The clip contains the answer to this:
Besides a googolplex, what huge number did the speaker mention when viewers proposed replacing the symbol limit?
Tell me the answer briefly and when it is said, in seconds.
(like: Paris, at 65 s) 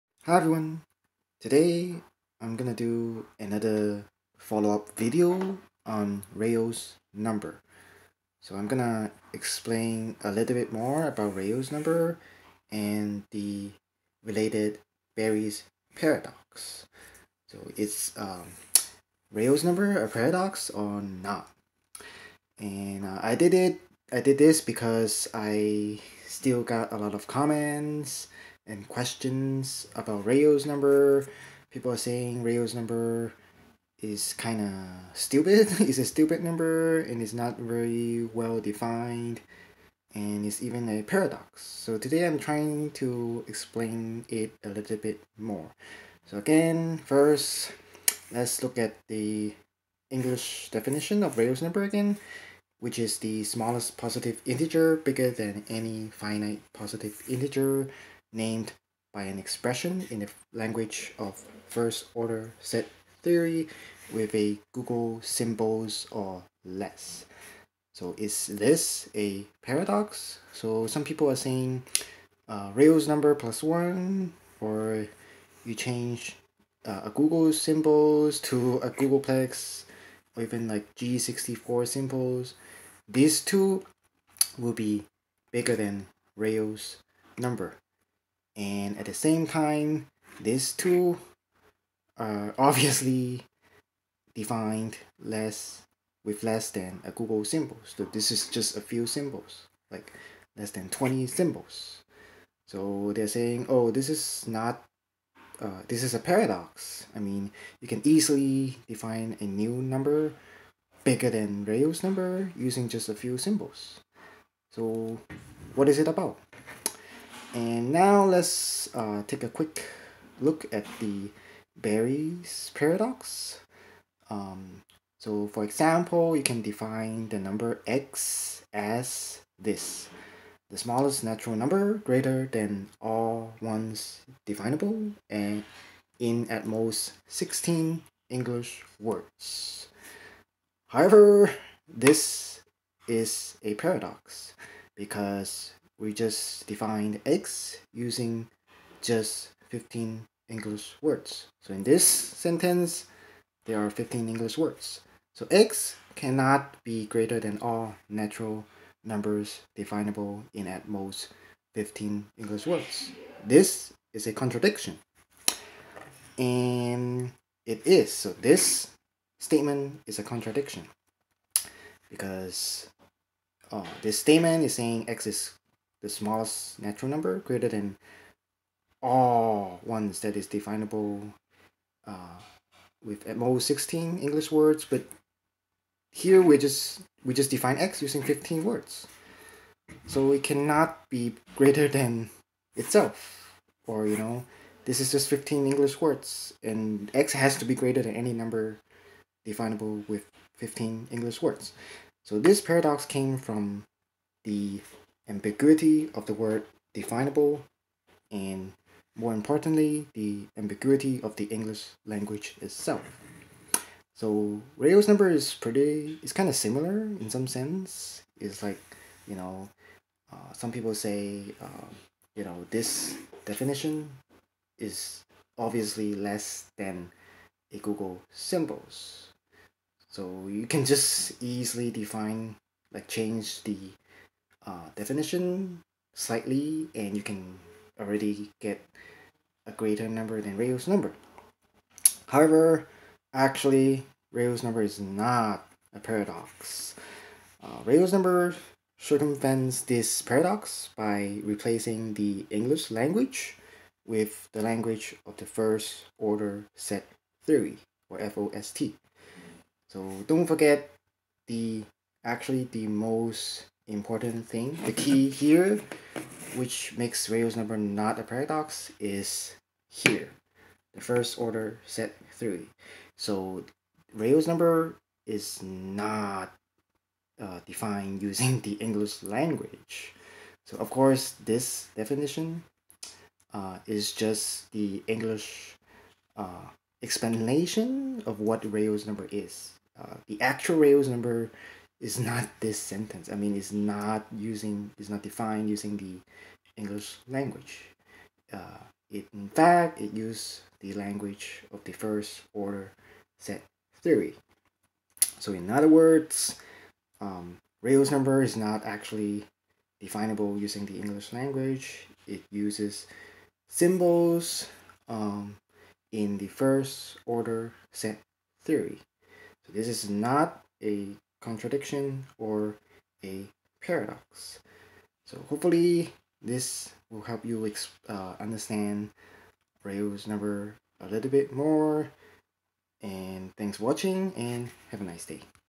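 G64, at 80 s.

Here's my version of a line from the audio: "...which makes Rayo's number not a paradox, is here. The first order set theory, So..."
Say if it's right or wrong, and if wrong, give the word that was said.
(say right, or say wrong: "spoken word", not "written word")
right.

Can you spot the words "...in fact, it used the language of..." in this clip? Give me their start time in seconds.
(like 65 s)
299 s.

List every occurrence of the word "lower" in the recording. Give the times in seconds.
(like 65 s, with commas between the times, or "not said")
not said.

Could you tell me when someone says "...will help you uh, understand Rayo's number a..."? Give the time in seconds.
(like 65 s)
327 s.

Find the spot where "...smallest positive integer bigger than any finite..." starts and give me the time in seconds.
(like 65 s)
53 s.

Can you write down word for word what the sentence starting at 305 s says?
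So in other words, um, number is not actually definable using the English language.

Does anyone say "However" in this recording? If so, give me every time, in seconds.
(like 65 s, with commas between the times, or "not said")
140 s, 242 s.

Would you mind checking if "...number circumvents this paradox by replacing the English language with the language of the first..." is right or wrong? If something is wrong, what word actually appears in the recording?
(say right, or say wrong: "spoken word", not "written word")
right.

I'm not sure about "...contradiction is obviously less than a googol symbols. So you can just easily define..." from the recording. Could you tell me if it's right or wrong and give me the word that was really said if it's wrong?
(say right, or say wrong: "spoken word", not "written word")
wrong: "definition", not "contradiction".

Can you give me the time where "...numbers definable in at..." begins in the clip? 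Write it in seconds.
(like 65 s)
159 s.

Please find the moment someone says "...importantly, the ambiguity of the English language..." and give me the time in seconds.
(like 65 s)
209 s.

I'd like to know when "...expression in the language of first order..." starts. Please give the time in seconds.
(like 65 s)
59 s.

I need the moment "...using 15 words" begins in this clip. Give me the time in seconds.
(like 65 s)
188 s.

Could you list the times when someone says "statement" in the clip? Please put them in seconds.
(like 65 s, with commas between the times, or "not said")
169 s, 174 s.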